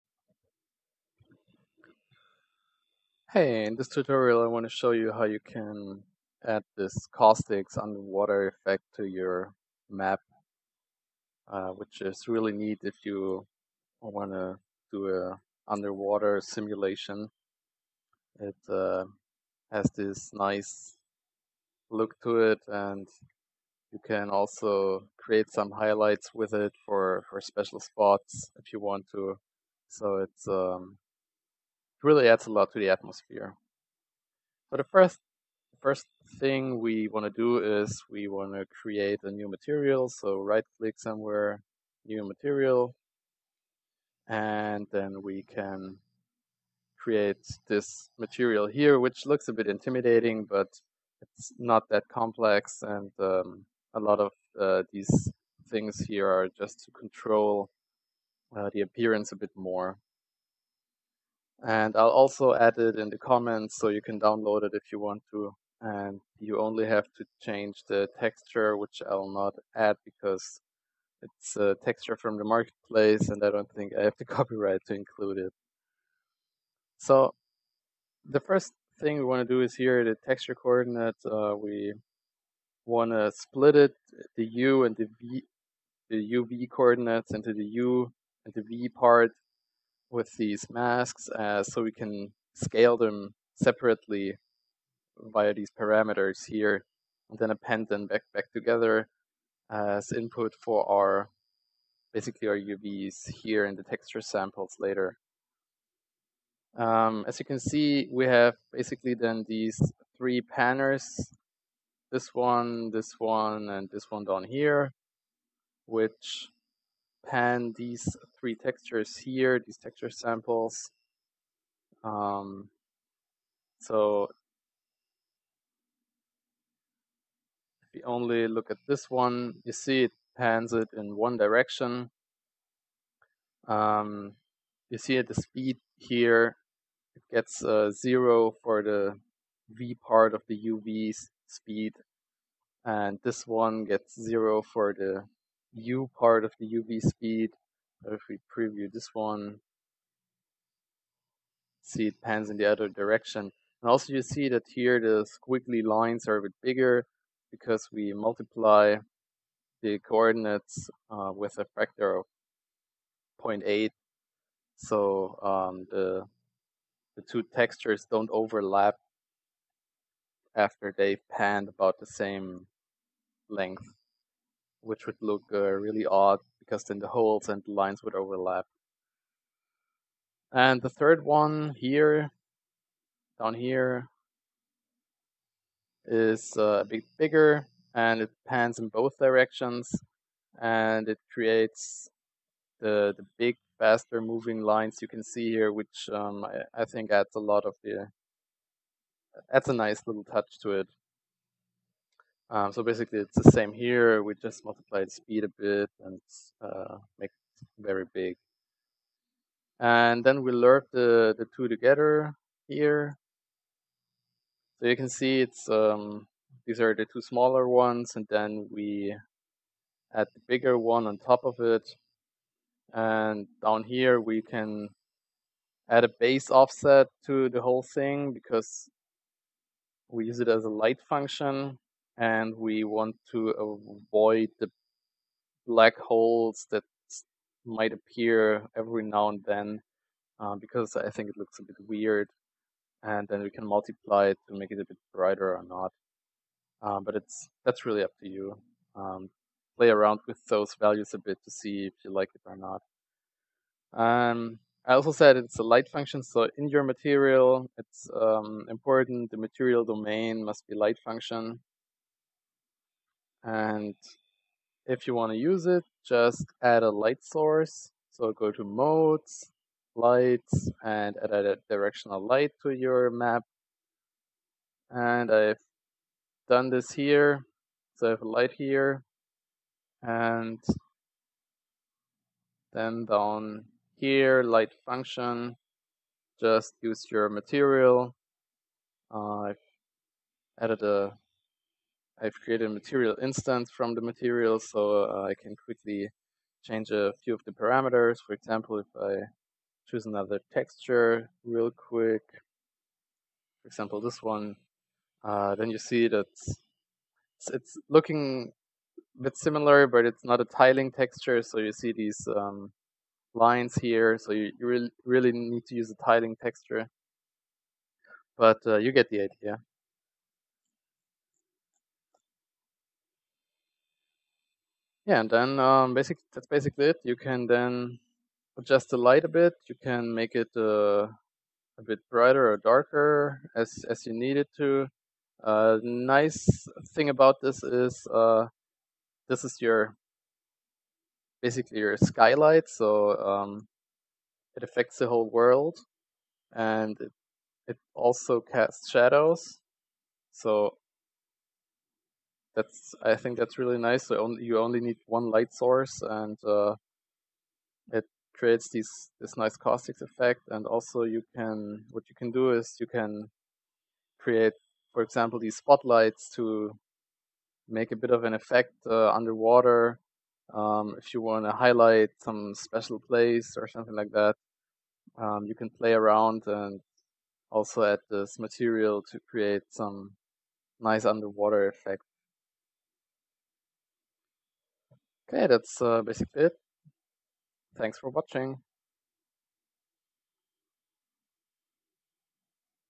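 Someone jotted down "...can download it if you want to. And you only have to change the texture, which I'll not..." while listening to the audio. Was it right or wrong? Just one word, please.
right.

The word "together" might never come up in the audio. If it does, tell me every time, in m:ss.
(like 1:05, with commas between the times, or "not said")
1:38, 3:31.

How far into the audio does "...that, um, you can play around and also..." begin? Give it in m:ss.
6:14.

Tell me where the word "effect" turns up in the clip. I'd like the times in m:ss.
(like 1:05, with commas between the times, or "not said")
0:08, 6:00, 6:08, 6:21.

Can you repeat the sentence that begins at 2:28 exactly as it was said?
But if we preview this one, see it pans in the other direction.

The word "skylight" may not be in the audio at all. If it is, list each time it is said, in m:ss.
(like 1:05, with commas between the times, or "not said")
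5:41.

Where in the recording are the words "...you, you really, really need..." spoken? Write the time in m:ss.
5:14.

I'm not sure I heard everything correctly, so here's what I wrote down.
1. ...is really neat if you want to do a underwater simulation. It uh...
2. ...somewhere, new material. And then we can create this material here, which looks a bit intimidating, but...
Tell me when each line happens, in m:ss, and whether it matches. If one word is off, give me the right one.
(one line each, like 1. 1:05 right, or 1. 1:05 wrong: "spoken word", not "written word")
1. 0:12 right
2. 0:40 right.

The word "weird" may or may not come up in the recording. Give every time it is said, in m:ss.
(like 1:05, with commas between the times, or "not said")
4:01.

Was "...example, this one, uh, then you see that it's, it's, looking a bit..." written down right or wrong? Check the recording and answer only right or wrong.
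right.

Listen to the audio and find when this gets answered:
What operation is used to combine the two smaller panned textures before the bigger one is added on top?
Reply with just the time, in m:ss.
3:30.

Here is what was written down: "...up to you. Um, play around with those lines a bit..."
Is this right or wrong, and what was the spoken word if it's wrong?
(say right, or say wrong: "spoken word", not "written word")
wrong: "values", not "lines".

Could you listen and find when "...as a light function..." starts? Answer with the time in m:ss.
3:50.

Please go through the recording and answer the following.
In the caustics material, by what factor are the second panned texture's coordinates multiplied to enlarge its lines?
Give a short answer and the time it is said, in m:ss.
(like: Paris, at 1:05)
0.8, at 2:43.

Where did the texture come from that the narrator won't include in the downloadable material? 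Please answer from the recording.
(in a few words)
the marketplace.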